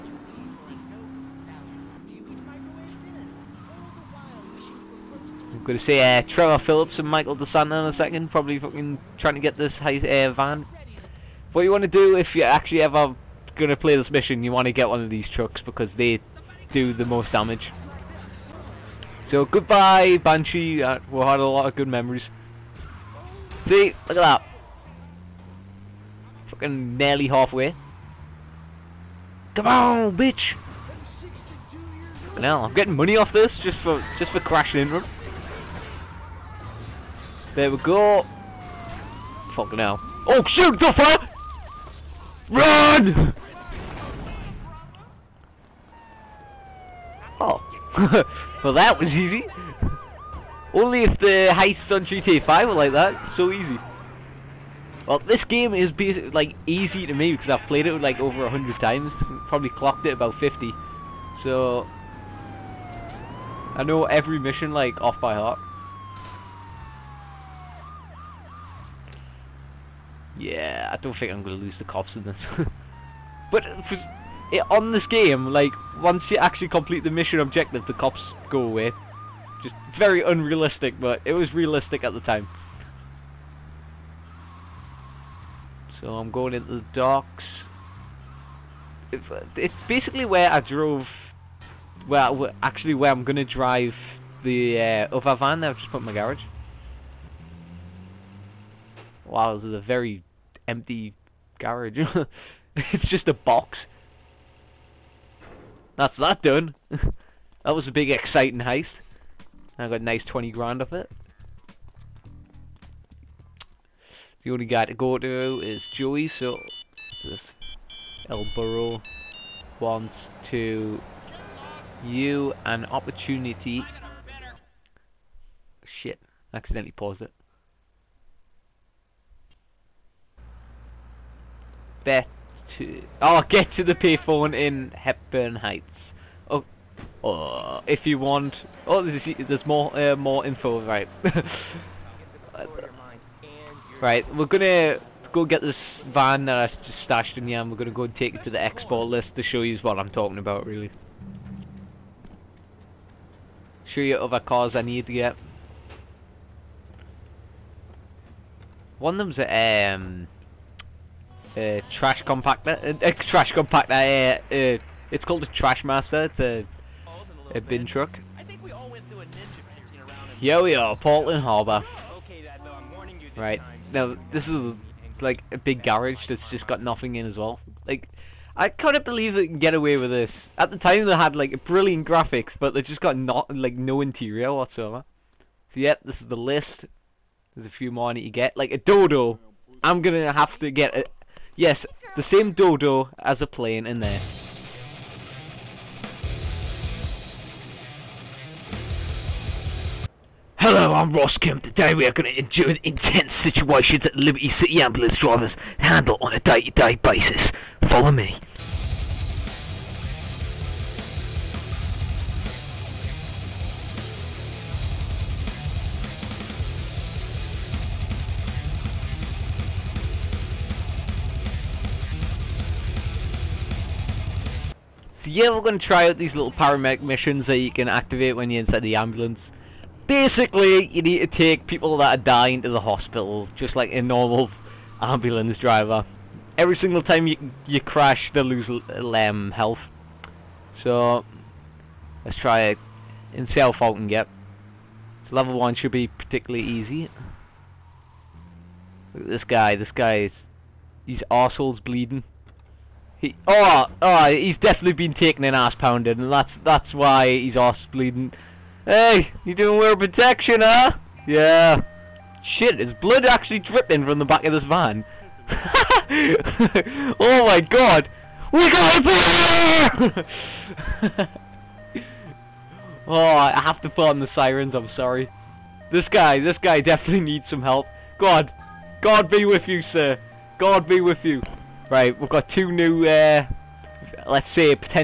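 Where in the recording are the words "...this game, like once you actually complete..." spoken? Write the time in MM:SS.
01:14.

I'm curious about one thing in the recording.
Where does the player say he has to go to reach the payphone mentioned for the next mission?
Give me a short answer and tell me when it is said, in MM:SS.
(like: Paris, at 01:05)
Hepburn Heights, at 02:14.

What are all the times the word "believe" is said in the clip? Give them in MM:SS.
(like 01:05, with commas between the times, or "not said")
02:59.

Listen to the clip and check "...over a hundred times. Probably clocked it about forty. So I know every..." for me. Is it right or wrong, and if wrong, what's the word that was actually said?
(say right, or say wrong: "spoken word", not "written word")
wrong: "fifty", not "forty".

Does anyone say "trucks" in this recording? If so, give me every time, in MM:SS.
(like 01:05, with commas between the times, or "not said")
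00:15, 02:47.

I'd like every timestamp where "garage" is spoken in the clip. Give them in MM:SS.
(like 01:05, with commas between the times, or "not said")
01:36, 01:41, 02:55.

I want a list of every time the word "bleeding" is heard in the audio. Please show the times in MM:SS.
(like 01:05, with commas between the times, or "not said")
04:11, 04:17.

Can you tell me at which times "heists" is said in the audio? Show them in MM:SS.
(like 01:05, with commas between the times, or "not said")
00:51, 01:48.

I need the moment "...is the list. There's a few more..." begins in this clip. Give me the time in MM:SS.
03:06.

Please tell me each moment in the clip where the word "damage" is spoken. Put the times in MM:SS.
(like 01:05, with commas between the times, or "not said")
00:17.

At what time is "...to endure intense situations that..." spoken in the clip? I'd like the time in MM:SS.
03:22.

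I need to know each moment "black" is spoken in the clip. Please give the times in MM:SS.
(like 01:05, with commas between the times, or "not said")
not said.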